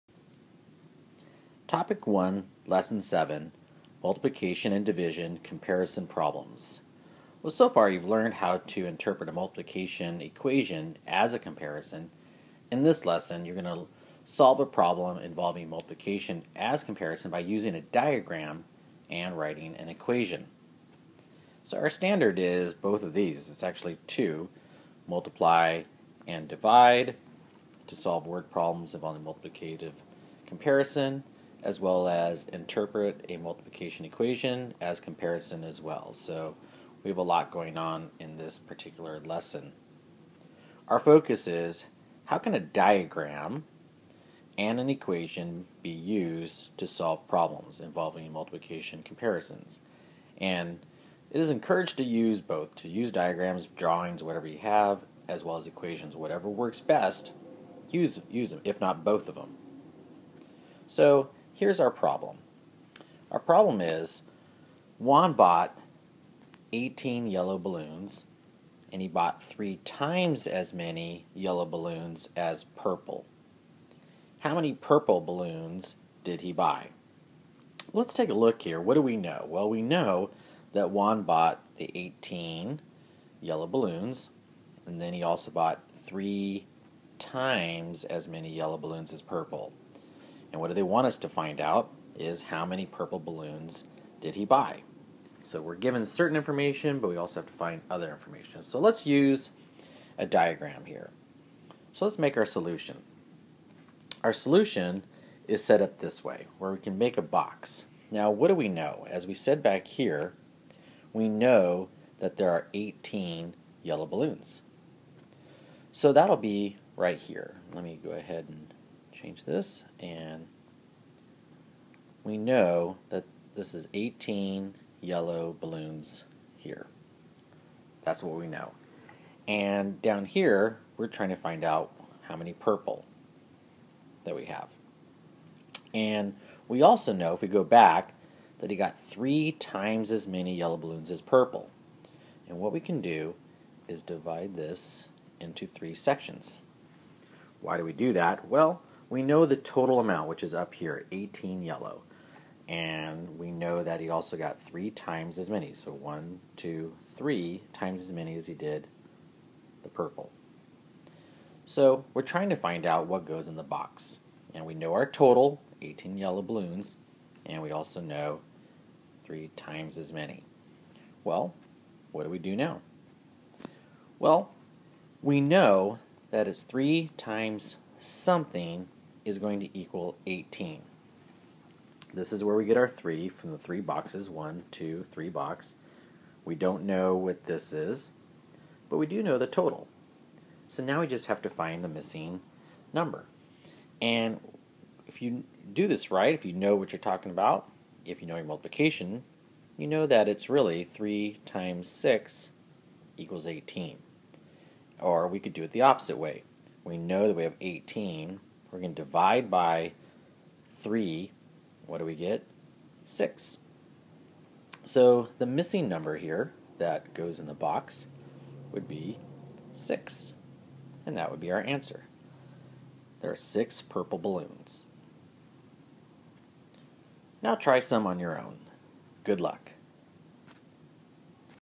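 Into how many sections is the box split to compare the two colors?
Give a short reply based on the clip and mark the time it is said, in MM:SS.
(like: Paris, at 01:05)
3, at 02:25.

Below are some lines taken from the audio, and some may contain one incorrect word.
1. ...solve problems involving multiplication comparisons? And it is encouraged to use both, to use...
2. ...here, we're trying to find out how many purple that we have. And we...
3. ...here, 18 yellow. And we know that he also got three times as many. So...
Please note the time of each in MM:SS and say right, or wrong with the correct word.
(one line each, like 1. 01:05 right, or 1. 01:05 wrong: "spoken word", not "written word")
1. 00:46 right
2. 02:10 right
3. 02:30 right.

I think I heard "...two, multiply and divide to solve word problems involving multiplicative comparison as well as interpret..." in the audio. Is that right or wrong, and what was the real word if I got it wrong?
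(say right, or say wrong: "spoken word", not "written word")
right.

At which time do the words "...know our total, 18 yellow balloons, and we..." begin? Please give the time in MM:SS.
02:44.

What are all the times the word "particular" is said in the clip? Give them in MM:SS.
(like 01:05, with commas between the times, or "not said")
00:38.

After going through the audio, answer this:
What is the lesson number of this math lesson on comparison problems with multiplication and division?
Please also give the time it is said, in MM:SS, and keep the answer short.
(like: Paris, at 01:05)
7, at 00:02.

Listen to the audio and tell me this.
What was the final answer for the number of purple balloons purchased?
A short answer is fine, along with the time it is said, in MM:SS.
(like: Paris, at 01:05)
6, at 03:43.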